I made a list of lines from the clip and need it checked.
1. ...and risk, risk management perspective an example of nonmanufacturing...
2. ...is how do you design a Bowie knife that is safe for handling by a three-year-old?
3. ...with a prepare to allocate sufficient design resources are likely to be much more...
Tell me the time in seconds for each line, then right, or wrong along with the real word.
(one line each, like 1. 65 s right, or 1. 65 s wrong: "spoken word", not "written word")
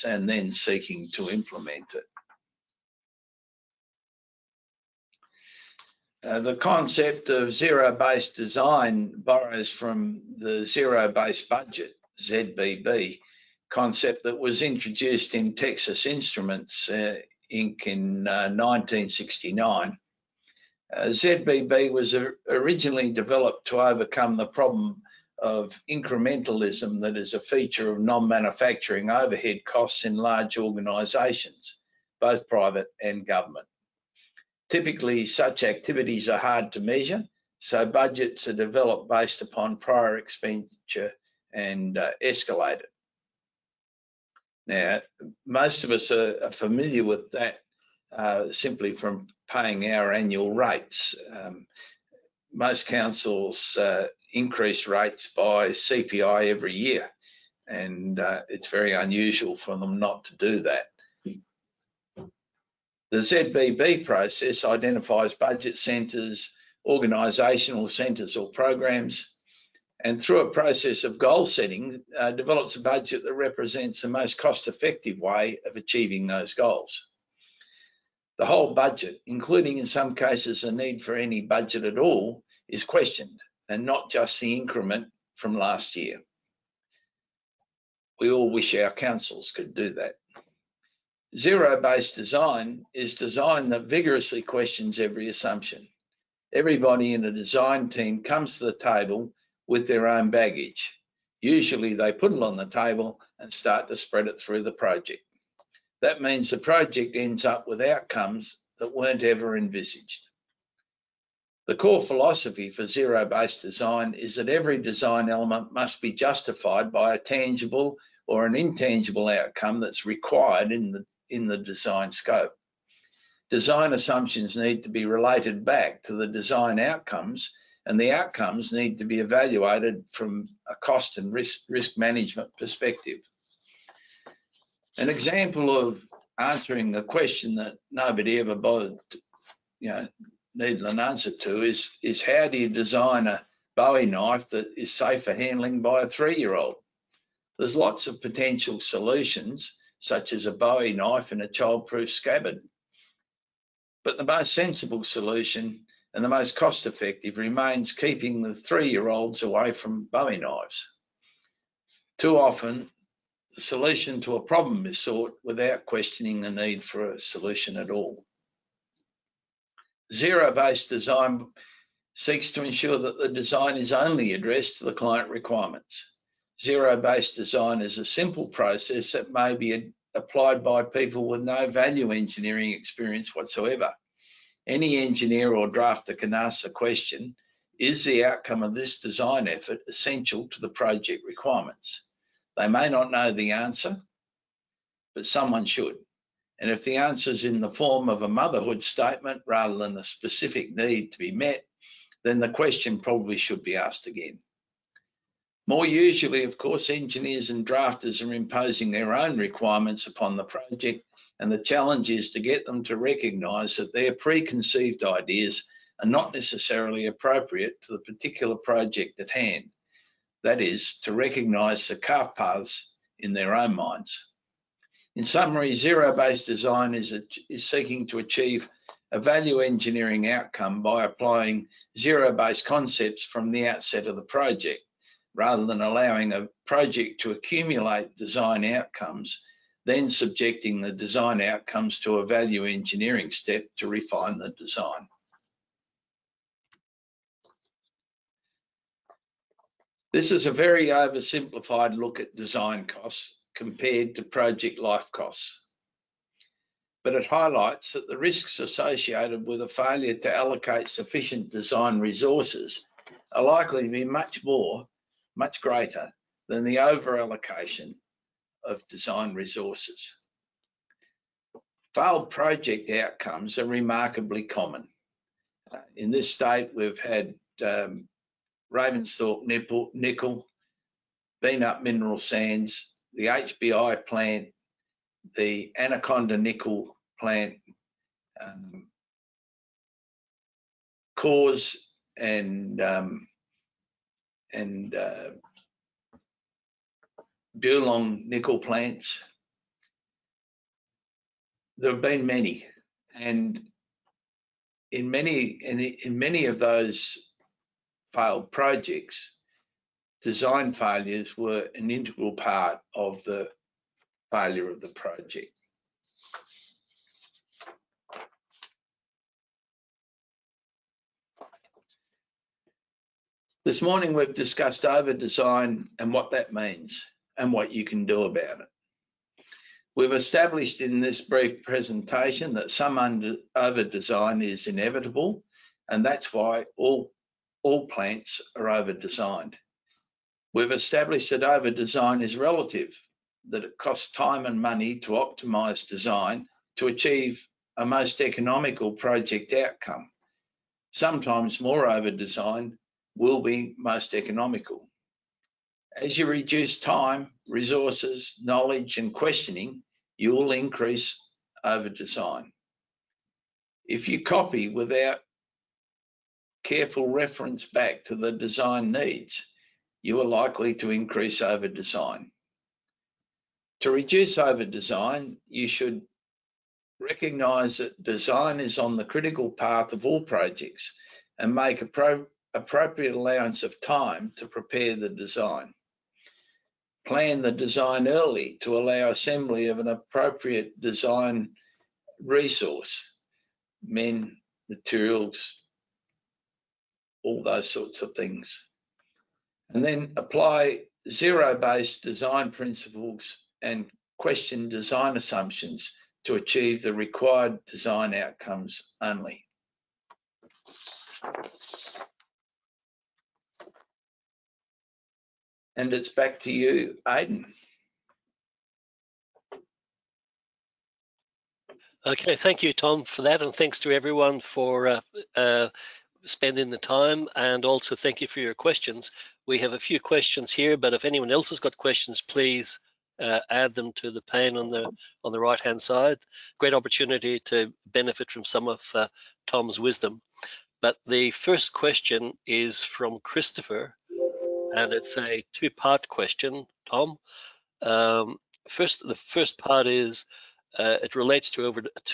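1. 131 s wrong: "answering", not "nonmanufacturing"
2. 142 s right
3. 259 s wrong: "failure", not "prepare".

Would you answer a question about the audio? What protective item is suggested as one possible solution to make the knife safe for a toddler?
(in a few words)
child-proof scabbard.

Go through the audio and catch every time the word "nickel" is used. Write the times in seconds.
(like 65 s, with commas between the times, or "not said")
279 s, 286 s, 297 s.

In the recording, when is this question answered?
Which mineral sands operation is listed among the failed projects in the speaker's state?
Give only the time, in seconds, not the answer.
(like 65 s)
281 s.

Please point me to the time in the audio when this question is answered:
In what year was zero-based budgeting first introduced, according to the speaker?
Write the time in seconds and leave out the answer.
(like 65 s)
18 s.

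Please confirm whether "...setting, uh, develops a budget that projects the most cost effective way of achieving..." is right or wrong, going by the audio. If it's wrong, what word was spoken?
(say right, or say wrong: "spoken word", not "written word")
wrong: "represents", not "projects".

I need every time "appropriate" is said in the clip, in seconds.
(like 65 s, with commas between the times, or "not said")
217 s, 382 s, 389 s.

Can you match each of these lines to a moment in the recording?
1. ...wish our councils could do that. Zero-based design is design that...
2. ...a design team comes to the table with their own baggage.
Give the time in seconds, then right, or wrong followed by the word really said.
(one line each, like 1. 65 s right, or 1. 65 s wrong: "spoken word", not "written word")
1. 88 s right
2. 97 s right.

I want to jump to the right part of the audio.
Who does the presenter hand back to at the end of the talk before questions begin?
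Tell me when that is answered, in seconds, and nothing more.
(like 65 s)
417 s.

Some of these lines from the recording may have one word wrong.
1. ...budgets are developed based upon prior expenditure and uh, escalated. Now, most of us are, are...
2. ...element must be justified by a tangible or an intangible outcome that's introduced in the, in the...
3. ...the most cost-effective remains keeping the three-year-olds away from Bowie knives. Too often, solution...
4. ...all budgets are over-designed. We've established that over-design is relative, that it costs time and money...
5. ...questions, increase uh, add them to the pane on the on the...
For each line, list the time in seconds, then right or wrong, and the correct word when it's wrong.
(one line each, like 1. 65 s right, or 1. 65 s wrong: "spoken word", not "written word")
1. 37 s right
2. 115 s wrong: "required", not "introduced"
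3. 156 s right
4. 337 s wrong: "plants", not "budgets"
5. 431 s wrong: "please", not "increase".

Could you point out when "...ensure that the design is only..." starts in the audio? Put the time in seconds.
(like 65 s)
172 s.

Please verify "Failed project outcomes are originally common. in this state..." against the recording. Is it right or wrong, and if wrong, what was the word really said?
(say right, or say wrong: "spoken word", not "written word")
wrong: "remarkably", not "originally".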